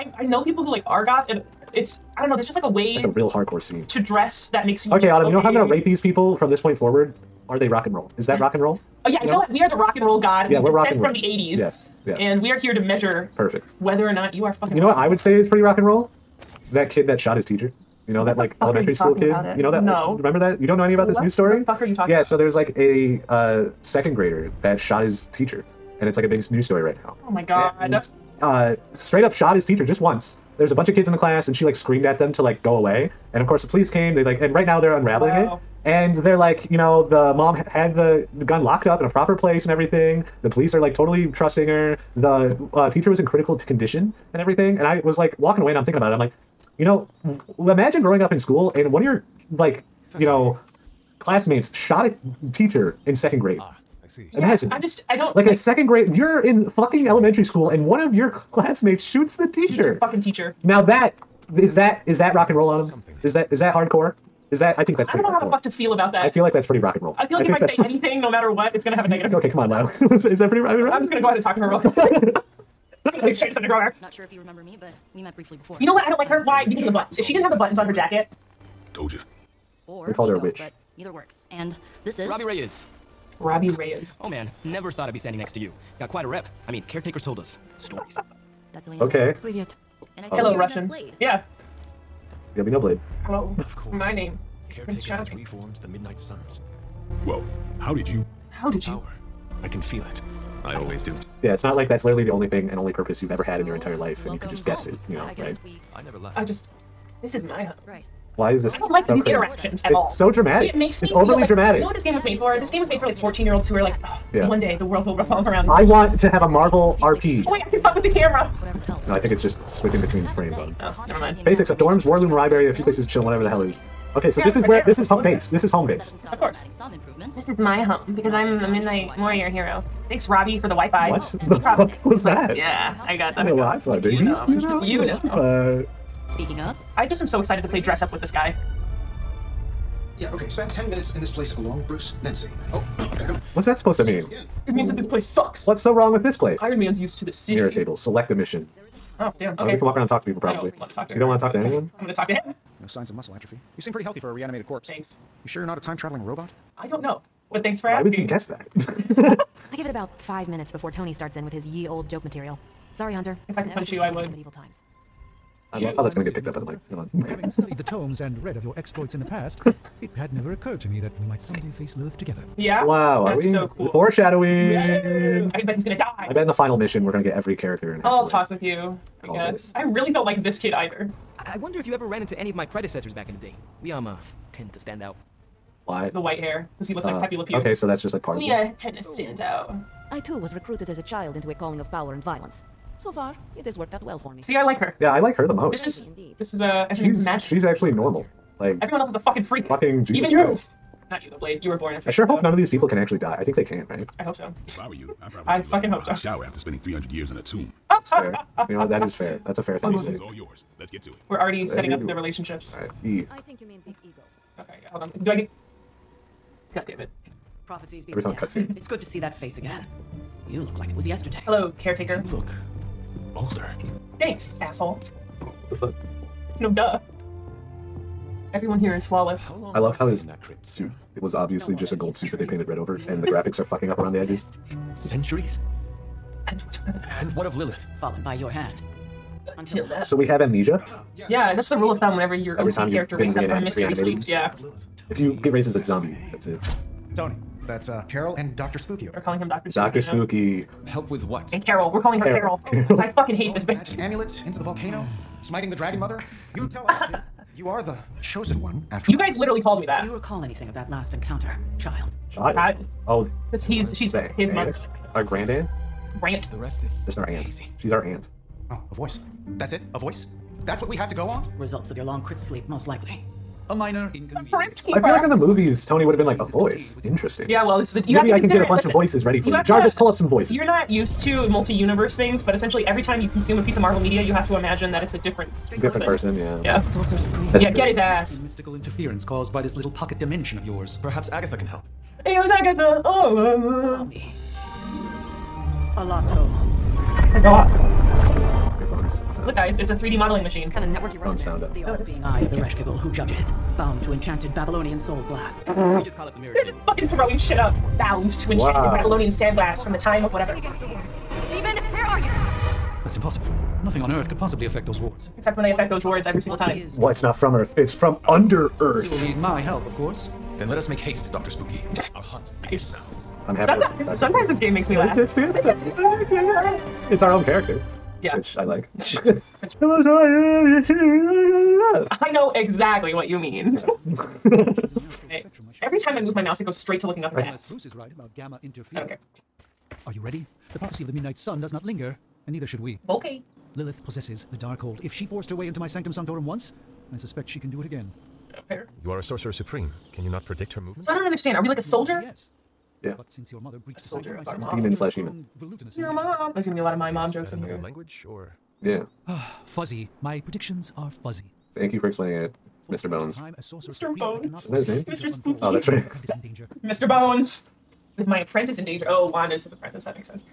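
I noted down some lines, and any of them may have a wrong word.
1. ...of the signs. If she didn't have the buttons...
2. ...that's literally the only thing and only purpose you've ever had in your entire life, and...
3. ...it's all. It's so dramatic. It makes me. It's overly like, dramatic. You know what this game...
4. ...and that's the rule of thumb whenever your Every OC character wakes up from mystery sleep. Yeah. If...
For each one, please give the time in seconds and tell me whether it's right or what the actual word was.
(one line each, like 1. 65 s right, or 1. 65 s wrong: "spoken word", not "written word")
1. 76 s wrong: "buttons", not "signs"
2. 101 s right
3. 109 s right
4. 241 s right.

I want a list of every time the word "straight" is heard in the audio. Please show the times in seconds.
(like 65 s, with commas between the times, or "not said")
28 s, 336 s.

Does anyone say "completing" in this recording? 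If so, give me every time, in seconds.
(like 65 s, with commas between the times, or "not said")
not said.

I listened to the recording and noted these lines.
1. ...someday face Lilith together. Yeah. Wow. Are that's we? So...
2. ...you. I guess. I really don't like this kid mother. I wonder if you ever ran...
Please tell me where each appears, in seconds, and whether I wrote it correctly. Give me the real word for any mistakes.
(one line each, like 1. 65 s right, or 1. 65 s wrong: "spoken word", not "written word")
1. 171 s right
2. 178 s wrong: "either", not "mother".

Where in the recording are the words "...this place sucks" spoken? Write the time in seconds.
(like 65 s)
144 s.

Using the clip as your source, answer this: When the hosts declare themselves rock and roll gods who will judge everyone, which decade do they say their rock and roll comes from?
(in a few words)
1980s.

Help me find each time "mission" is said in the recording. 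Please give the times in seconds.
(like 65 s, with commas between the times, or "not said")
148 s, 176 s.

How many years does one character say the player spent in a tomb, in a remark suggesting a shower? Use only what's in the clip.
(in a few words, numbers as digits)
300.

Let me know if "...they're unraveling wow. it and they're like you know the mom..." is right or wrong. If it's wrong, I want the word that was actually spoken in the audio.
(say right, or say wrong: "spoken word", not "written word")
right.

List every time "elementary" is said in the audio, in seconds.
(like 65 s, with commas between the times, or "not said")
18 s, 57 s.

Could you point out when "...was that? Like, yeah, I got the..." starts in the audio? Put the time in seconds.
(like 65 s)
132 s.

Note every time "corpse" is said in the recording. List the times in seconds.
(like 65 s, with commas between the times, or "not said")
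154 s.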